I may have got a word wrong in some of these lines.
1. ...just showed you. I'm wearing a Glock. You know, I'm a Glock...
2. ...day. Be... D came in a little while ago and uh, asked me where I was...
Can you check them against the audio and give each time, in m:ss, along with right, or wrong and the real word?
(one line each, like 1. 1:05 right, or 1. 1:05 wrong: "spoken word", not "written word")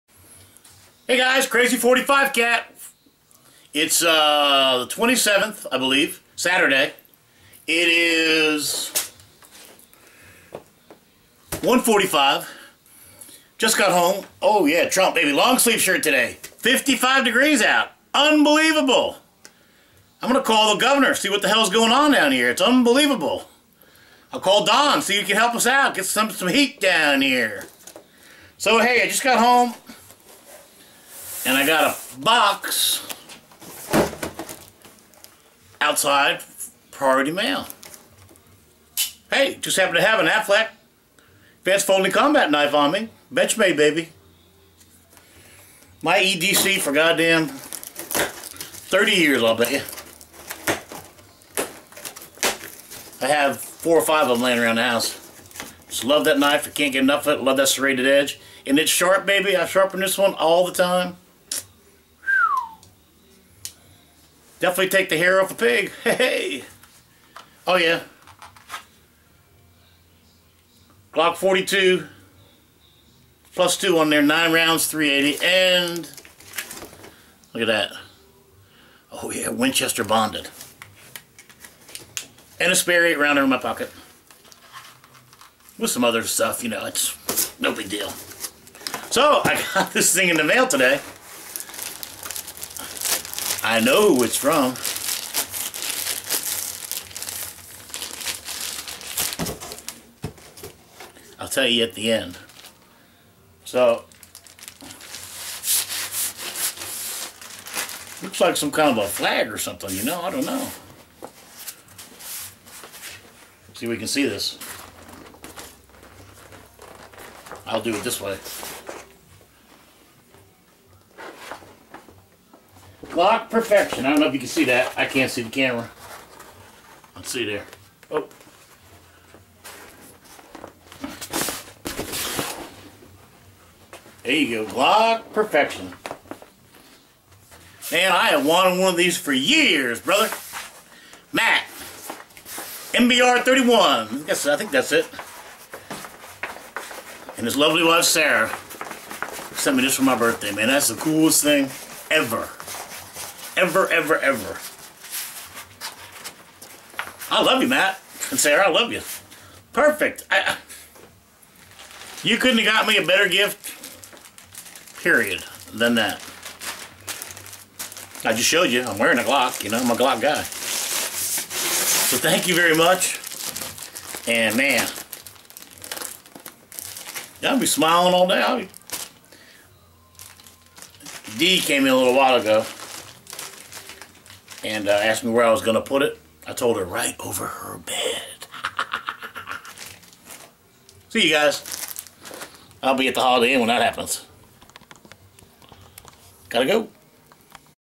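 1. 2:48 right
2. 2:58 right.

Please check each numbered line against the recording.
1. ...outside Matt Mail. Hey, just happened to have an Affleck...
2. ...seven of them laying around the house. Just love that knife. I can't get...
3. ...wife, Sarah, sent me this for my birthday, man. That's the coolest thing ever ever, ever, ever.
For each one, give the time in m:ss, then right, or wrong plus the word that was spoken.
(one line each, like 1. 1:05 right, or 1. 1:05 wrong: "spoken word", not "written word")
1. 0:35 wrong: "Priority", not "Matt"
2. 0:54 wrong: "five", not "seven"
3. 2:27 right.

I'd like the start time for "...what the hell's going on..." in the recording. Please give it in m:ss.
0:21.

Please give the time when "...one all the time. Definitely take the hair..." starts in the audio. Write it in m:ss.
1:00.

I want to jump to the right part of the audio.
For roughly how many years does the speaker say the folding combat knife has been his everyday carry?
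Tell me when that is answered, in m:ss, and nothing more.
0:47.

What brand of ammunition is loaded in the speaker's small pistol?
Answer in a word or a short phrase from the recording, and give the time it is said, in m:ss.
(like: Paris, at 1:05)
Winchester bonded, at 1:19.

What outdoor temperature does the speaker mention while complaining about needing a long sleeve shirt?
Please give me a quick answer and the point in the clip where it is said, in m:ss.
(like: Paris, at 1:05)
55 degrees, at 0:16.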